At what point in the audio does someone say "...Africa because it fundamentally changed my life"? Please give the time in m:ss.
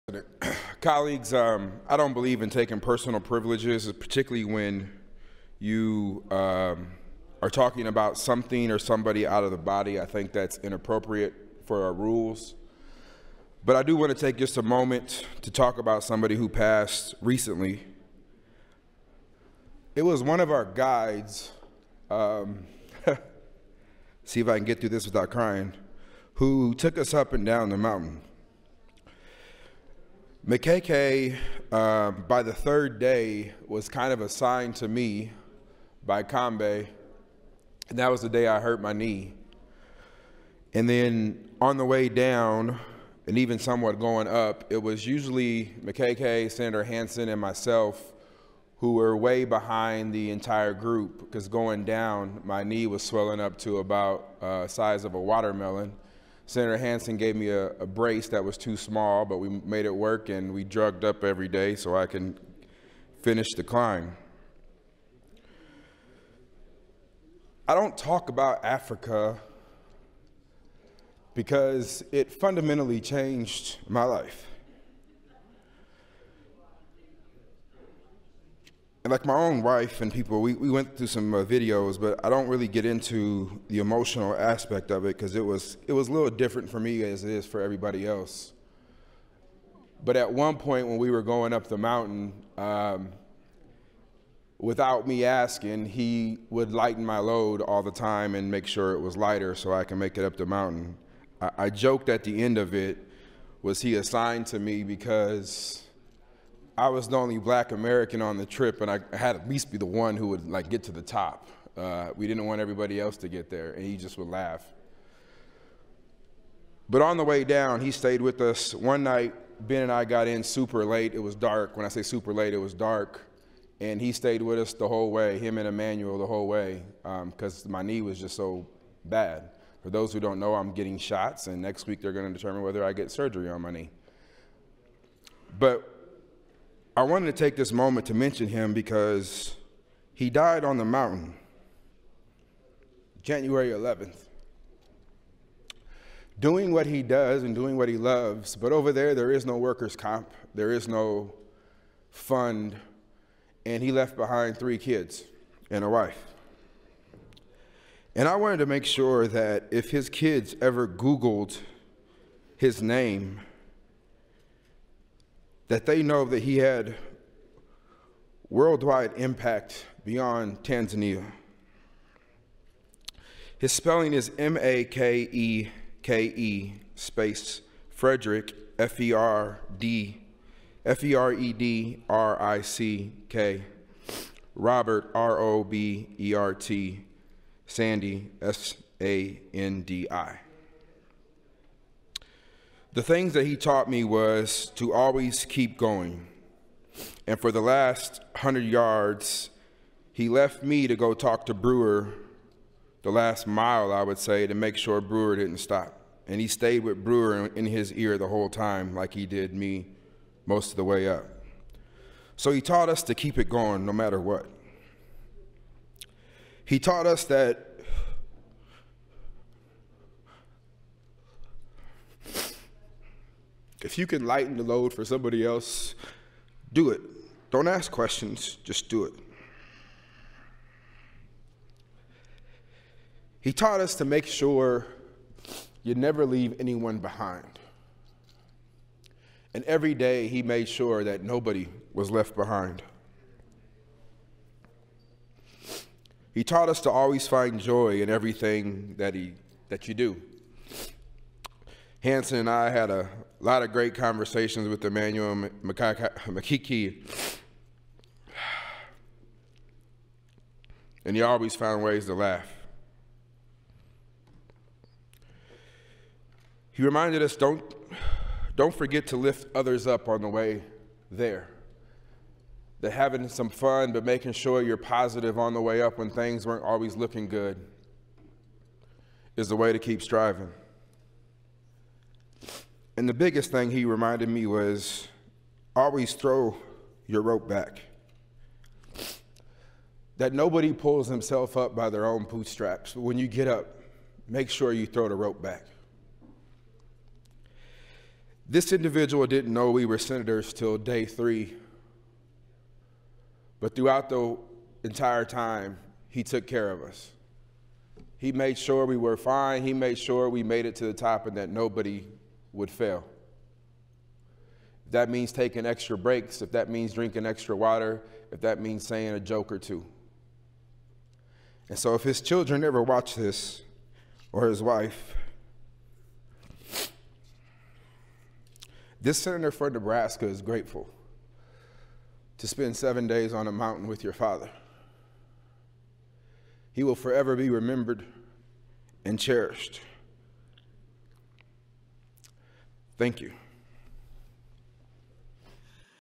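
1:08.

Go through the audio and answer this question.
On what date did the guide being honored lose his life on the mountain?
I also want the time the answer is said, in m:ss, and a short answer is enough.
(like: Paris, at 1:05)
January 11, at 2:23.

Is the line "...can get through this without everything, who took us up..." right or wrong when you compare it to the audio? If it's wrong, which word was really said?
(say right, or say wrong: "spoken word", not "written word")
wrong: "crying", not "everything".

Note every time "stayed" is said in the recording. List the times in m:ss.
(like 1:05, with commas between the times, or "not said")
1:57, 2:04, 3:26.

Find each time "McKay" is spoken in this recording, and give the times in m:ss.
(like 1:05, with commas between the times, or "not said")
0:30, 0:45.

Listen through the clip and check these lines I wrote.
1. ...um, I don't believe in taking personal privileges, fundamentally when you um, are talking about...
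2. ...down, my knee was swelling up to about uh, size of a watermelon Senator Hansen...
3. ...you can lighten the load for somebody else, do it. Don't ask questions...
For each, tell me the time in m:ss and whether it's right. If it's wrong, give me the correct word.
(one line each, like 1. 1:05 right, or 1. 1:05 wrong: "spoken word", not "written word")
1. 0:01 wrong: "particularly", not "fundamentally"
2. 0:51 right
3. 3:43 right.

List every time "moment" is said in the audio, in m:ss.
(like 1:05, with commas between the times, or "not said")
0:14, 2:17.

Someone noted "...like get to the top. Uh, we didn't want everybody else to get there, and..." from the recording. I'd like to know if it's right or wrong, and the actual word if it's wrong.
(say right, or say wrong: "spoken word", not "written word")
right.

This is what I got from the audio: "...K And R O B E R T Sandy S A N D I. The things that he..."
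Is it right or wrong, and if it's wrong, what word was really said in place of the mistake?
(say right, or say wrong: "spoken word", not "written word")
wrong: "Robert", not "And".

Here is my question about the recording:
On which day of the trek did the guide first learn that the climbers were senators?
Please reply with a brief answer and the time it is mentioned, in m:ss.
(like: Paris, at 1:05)
Day 3, at 5:00.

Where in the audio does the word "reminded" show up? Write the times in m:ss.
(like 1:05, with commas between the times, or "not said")
4:26, 4:43.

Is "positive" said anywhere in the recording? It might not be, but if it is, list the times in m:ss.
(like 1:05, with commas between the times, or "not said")
4:34.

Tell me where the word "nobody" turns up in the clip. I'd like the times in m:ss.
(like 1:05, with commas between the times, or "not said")
4:01, 4:50, 5:11.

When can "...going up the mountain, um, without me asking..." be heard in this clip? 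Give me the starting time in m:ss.
1:31.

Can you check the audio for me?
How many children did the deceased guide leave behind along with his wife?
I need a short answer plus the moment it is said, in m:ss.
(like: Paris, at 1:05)
3, at 2:34.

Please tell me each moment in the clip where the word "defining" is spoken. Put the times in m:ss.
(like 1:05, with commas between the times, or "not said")
not said.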